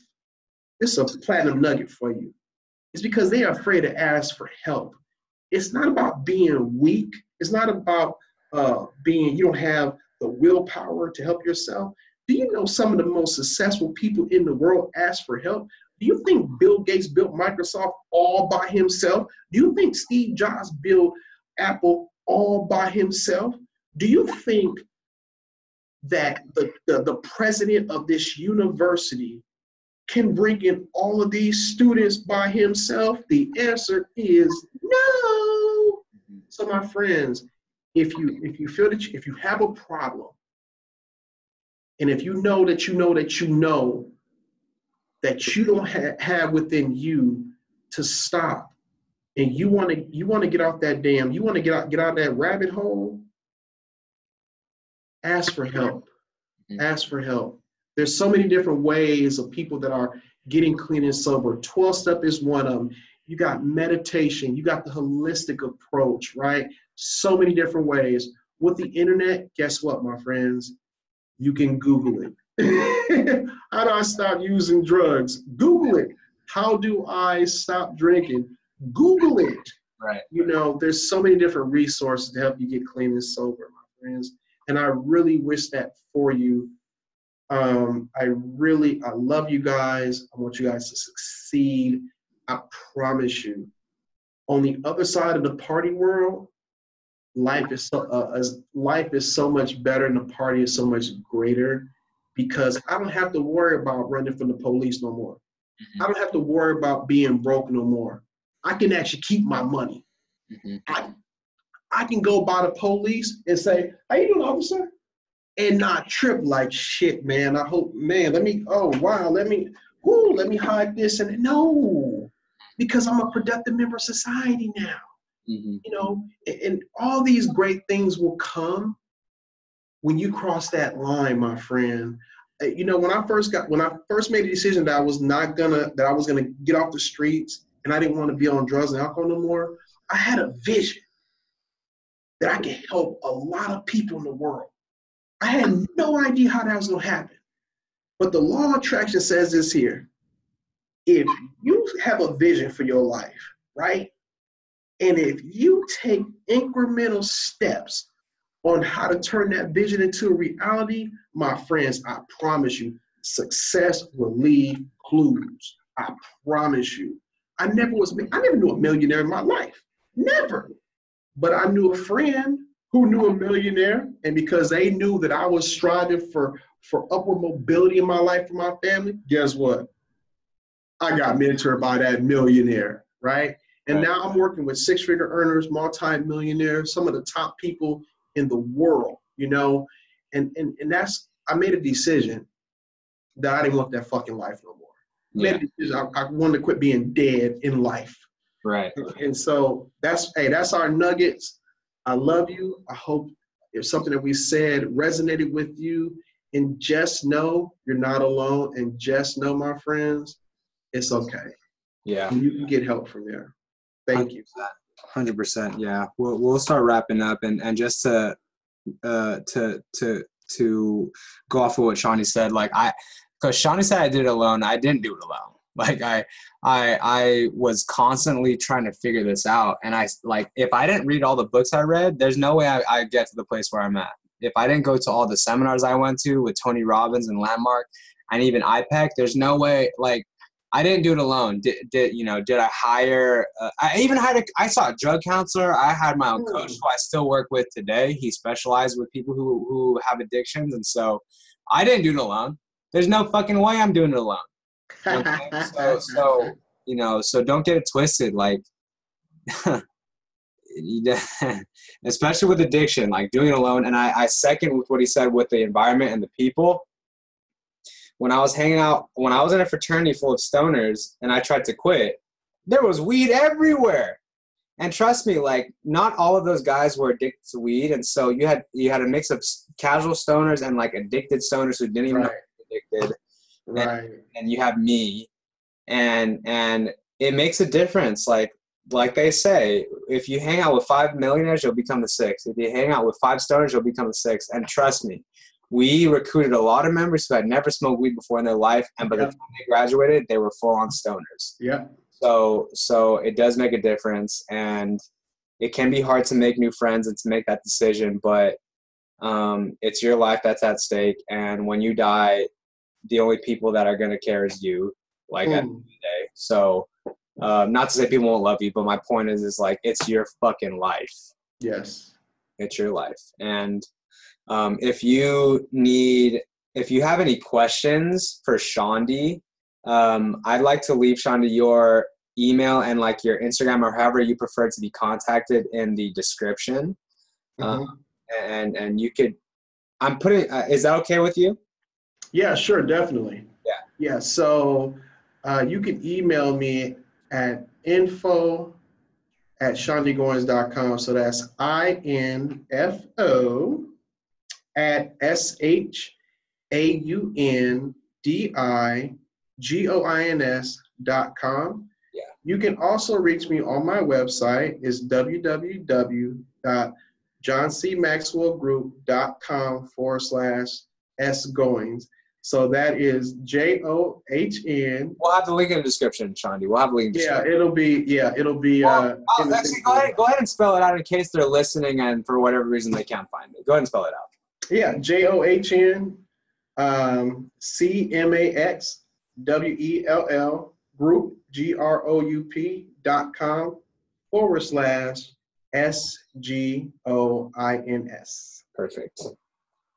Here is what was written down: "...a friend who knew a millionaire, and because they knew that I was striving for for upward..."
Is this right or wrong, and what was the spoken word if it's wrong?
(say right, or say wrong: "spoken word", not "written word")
right.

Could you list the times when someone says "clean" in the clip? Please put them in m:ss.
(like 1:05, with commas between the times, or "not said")
1:00, 1:22.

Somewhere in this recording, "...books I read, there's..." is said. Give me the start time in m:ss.
3:51.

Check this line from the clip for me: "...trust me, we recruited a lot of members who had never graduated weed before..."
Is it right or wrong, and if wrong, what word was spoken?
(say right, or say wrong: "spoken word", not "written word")
wrong: "smoked", not "graduated".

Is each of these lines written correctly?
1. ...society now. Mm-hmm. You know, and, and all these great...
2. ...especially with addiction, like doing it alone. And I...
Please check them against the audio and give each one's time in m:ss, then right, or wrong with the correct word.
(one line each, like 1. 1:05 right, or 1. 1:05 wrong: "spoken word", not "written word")
1. 2:04 right
2. 4:22 right.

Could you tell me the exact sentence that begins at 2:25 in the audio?
I had no idea how that was gonna happen.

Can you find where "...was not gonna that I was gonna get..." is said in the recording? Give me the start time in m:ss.
2:14.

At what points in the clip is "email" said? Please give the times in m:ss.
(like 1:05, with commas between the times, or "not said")
5:32, 5:46.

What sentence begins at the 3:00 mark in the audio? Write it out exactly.
I got mentored by that millionaire, right?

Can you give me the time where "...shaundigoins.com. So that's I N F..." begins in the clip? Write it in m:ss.
5:49.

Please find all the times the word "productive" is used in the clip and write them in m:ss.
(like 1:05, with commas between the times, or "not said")
2:03.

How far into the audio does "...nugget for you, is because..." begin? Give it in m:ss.
0:01.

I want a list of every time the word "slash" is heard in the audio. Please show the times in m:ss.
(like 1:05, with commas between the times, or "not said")
6:10, 6:34.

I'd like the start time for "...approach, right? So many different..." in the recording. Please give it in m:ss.
1:05.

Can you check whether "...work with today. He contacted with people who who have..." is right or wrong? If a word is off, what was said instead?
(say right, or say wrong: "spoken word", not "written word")
wrong: "specialized", not "contacted".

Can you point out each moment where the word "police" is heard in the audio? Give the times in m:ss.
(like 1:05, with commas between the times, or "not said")
1:44, 1:52.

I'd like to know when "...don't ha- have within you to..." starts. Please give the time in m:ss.
0:45.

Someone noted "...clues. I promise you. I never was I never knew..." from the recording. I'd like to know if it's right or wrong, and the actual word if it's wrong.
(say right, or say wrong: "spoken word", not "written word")
right.